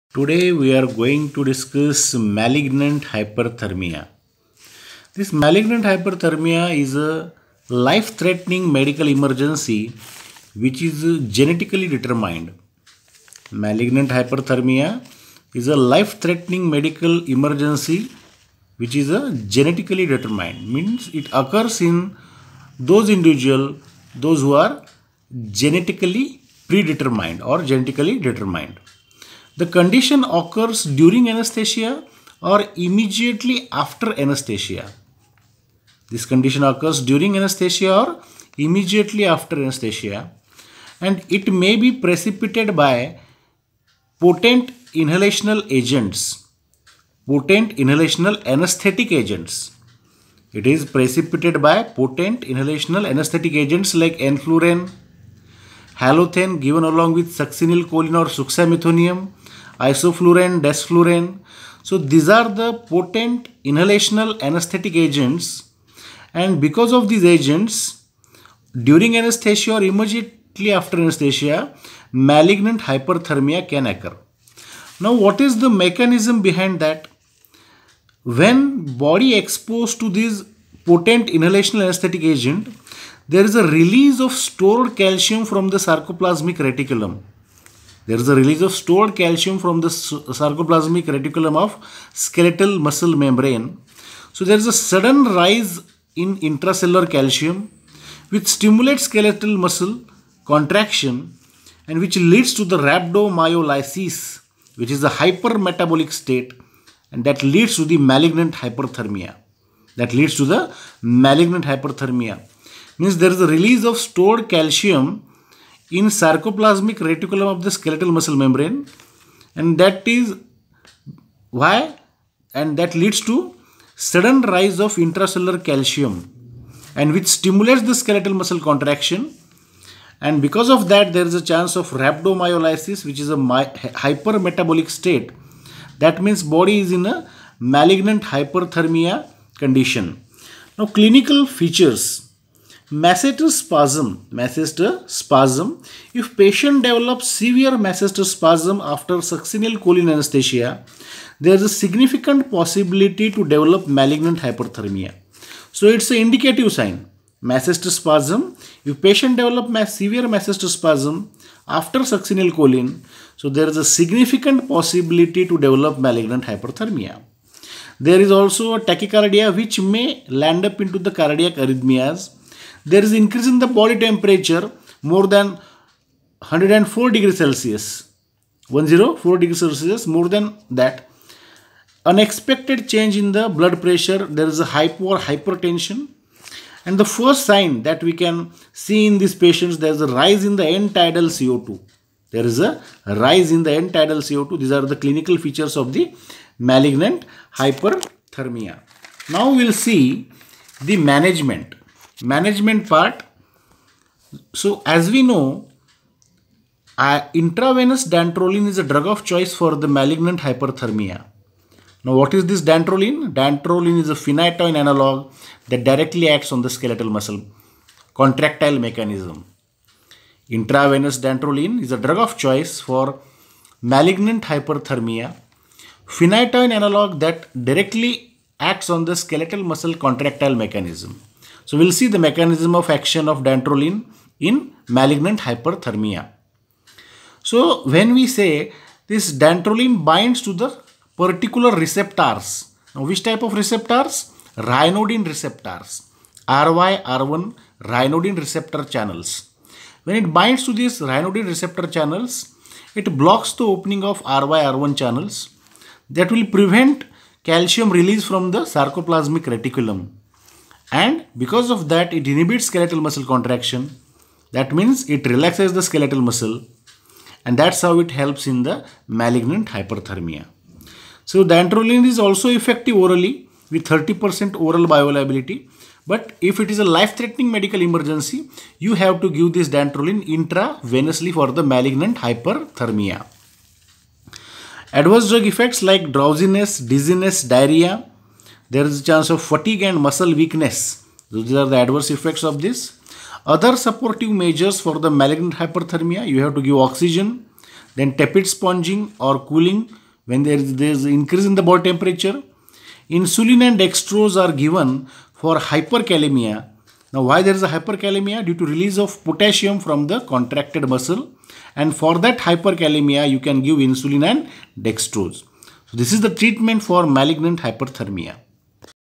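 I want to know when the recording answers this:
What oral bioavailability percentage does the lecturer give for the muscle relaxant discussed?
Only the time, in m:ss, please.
4:33.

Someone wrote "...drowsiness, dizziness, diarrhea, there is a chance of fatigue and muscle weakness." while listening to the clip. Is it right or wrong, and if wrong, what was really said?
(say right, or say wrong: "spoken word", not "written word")
right.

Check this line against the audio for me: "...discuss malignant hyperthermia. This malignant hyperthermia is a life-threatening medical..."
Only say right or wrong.
right.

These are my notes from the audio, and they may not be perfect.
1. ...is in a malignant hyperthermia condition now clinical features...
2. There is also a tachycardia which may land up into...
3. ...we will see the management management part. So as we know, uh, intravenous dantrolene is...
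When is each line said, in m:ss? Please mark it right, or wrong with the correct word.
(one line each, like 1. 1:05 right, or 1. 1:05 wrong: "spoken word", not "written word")
1. 2:16 right
2. 2:48 right
3. 3:19 right.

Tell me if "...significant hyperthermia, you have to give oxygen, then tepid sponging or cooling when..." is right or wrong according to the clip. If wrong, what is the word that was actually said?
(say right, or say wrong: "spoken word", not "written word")
wrong: "malignant", not "significant".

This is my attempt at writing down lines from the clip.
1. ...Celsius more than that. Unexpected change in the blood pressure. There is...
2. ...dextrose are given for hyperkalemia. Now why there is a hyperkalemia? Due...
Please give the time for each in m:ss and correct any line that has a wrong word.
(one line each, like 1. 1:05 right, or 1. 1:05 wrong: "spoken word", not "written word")
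1. 2:59 right
2. 5:03 right.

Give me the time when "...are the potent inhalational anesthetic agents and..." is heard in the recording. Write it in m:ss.
1:02.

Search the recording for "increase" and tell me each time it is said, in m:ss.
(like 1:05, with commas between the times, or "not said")
2:53, 5:01.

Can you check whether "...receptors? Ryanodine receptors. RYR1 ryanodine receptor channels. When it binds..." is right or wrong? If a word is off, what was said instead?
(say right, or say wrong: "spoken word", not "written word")
right.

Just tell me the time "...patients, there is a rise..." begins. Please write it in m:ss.
3:09.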